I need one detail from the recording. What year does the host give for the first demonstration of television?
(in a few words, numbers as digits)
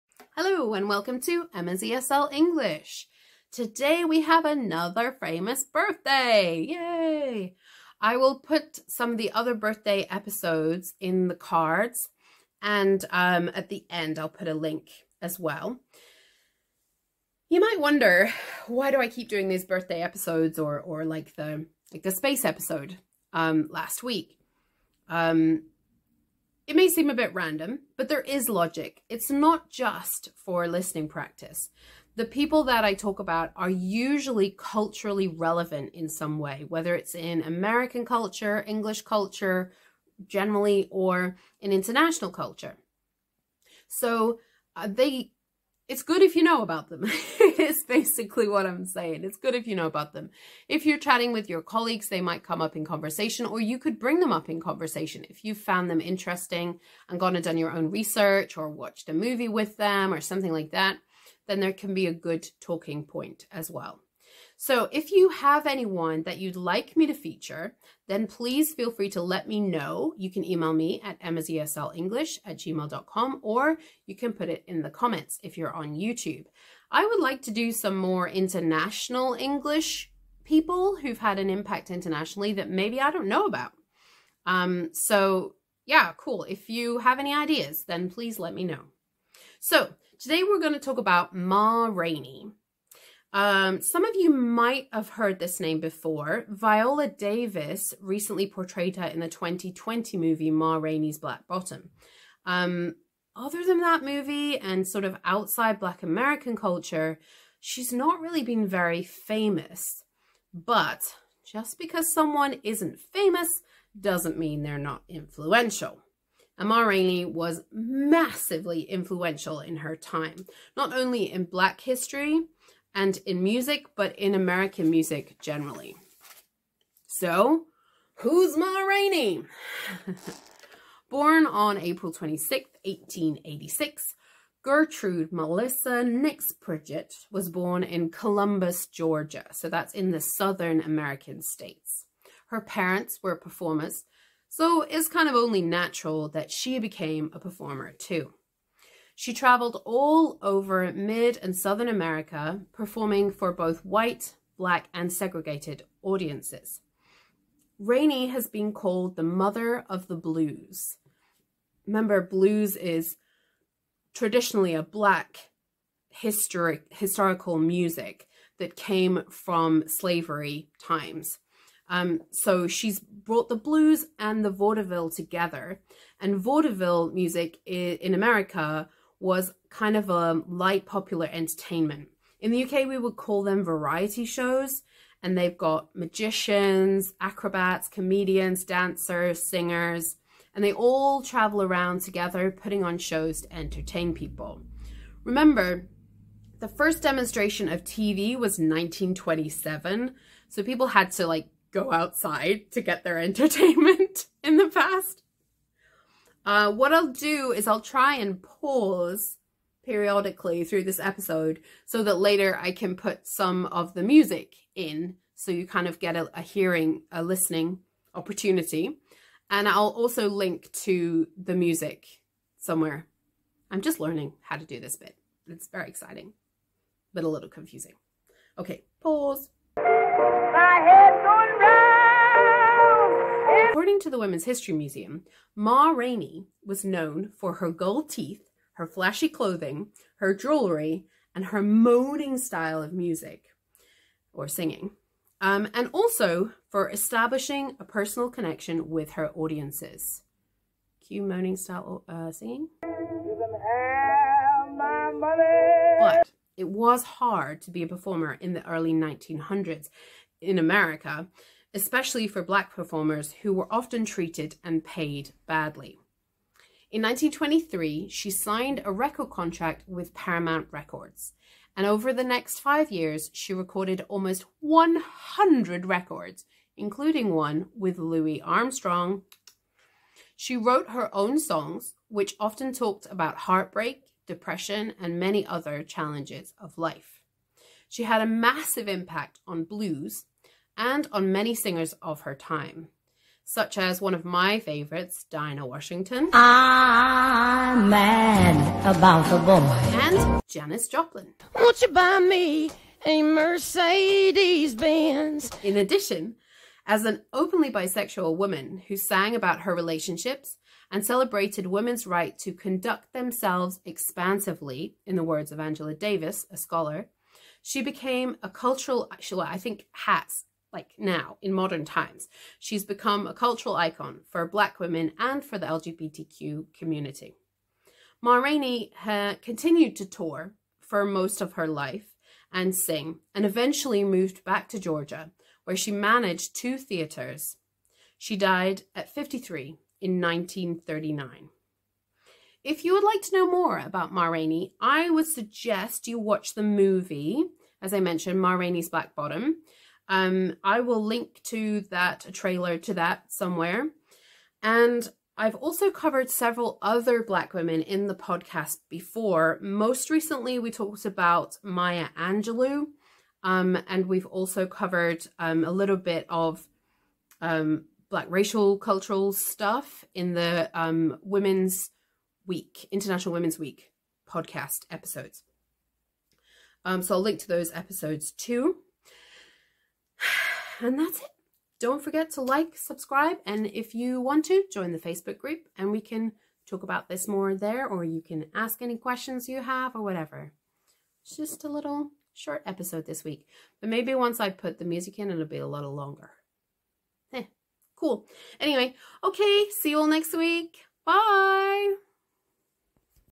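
1927.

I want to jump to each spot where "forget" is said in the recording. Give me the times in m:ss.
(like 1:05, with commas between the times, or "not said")
6:22.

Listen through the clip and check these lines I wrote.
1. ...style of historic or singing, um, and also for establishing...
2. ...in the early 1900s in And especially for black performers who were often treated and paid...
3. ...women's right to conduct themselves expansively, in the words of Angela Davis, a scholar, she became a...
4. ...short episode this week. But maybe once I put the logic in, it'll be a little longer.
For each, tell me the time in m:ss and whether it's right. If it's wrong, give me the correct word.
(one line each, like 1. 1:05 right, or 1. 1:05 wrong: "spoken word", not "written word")
1. 4:02 wrong: "music", not "historic"
2. 4:18 wrong: "America", not "And"
3. 5:11 right
4. 6:32 wrong: "music", not "logic".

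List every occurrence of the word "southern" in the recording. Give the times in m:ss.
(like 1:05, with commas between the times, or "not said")
2:20, 2:31.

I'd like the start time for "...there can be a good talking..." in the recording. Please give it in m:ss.
1:01.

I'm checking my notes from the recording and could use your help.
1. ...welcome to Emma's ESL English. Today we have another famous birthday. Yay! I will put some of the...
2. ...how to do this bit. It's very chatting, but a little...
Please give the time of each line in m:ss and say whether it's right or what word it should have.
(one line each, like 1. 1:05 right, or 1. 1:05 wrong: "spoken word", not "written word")
1. 0:00 right
2. 3:44 wrong: "exciting", not "chatting".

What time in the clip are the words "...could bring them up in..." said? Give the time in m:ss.
0:53.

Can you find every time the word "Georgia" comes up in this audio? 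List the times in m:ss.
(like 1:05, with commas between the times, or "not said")
2:18, 5:34.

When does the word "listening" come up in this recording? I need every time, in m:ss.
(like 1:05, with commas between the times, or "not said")
0:30, 3:37.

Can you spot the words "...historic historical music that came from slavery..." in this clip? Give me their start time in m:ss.
2:46.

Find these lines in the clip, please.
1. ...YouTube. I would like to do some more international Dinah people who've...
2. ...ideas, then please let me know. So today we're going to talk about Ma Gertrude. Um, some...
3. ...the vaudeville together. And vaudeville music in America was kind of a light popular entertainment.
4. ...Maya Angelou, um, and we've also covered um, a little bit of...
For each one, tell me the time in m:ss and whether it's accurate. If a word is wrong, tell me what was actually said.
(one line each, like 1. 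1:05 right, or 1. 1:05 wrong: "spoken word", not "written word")
1. 1:15 wrong: "English", not "Dinah"
2. 1:27 wrong: "Rainey", not "Gertrude"
3. 2:54 right
4. 6:01 right.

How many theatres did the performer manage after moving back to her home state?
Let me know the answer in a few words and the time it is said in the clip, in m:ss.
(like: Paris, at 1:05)
2, at 5:36.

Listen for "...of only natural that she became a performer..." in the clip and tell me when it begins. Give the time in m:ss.
2:25.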